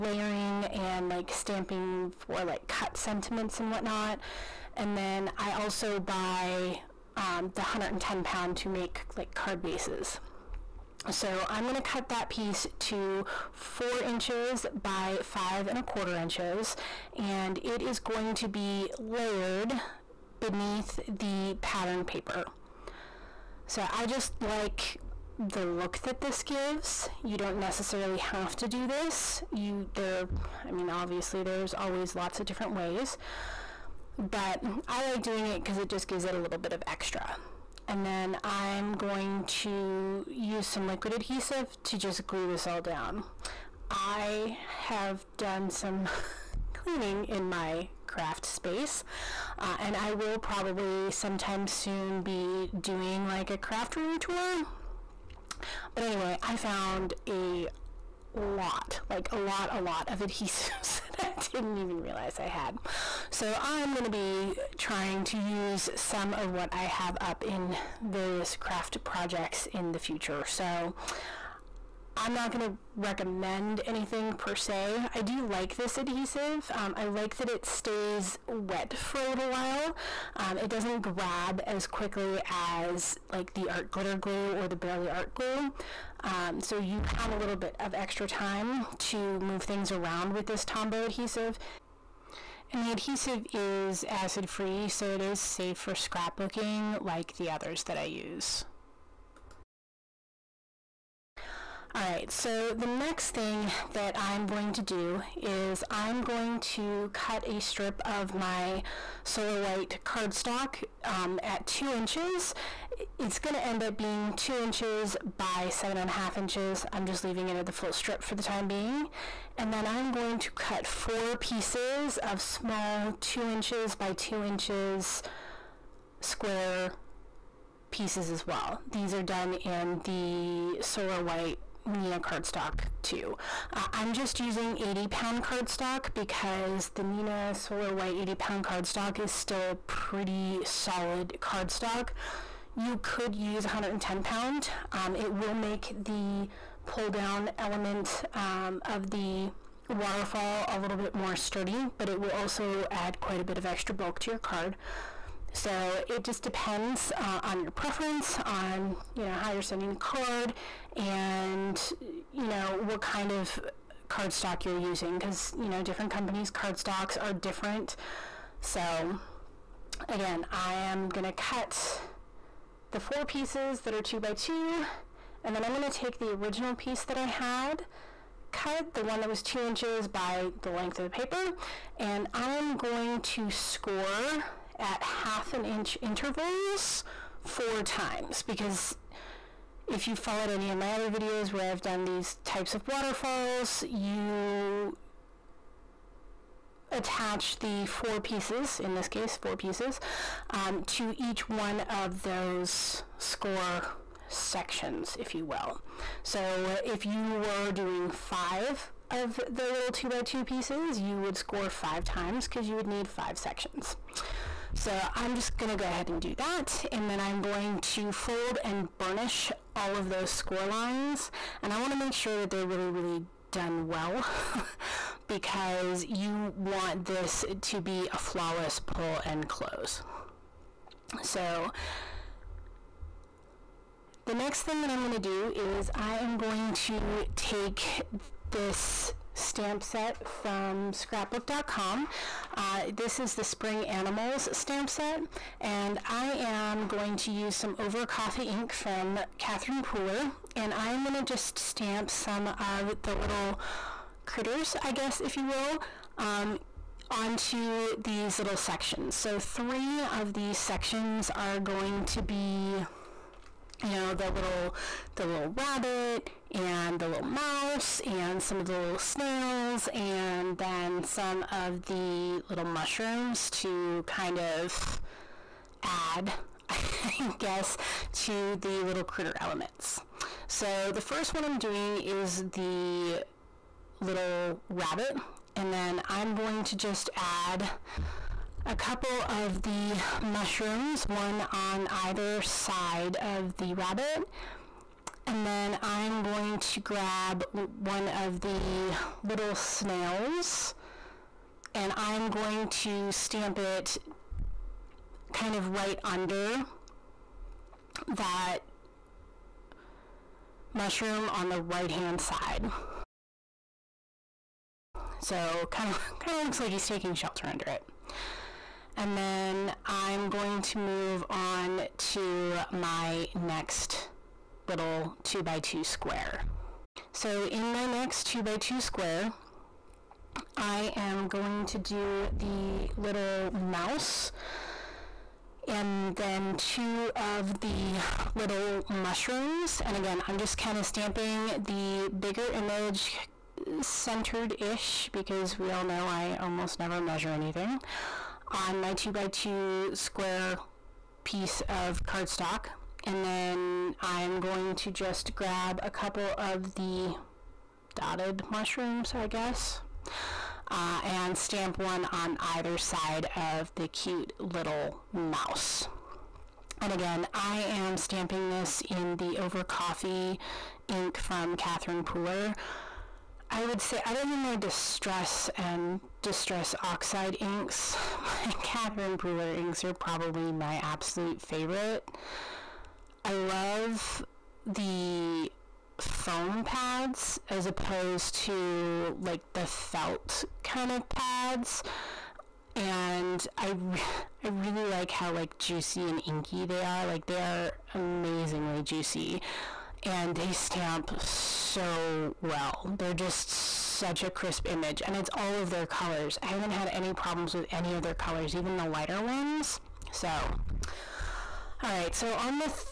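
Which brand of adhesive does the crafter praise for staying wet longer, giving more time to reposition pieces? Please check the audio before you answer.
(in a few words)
Tombow.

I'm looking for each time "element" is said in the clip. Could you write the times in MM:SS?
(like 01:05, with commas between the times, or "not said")
02:27, 04:39.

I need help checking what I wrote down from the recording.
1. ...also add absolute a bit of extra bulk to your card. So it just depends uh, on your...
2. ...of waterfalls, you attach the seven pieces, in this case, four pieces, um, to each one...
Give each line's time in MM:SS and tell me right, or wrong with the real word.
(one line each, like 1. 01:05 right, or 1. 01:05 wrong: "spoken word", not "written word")
1. 02:32 wrong: "quite", not "absolute"
2. 03:12 wrong: "four", not "seven".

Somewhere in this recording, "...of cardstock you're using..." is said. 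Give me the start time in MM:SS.
02:43.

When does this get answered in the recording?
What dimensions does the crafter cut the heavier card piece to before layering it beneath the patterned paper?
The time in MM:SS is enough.
00:13.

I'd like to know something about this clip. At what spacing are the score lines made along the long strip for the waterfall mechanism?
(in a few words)
Half an inch.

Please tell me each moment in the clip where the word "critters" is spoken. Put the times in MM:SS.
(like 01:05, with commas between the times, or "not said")
04:14, 04:39.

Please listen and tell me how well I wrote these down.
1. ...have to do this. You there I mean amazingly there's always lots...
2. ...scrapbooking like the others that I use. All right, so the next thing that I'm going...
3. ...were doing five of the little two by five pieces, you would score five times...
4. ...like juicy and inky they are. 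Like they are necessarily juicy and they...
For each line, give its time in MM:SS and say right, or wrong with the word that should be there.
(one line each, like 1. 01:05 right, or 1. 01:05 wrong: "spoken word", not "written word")
1. 00:28 wrong: "obviously", not "amazingly"
2. 01:35 right
3. 03:27 wrong: "two", not "five"
4. 06:35 wrong: "amazingly", not "necessarily".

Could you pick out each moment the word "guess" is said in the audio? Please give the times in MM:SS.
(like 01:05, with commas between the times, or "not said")
04:14, 04:37, 05:59.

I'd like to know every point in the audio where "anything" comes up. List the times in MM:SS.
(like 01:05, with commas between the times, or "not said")
01:13, 05:47.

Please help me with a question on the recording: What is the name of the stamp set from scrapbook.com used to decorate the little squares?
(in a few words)
Spring Animals.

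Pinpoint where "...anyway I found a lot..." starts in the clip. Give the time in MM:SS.
00:56.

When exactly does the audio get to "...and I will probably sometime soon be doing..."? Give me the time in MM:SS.
00:49.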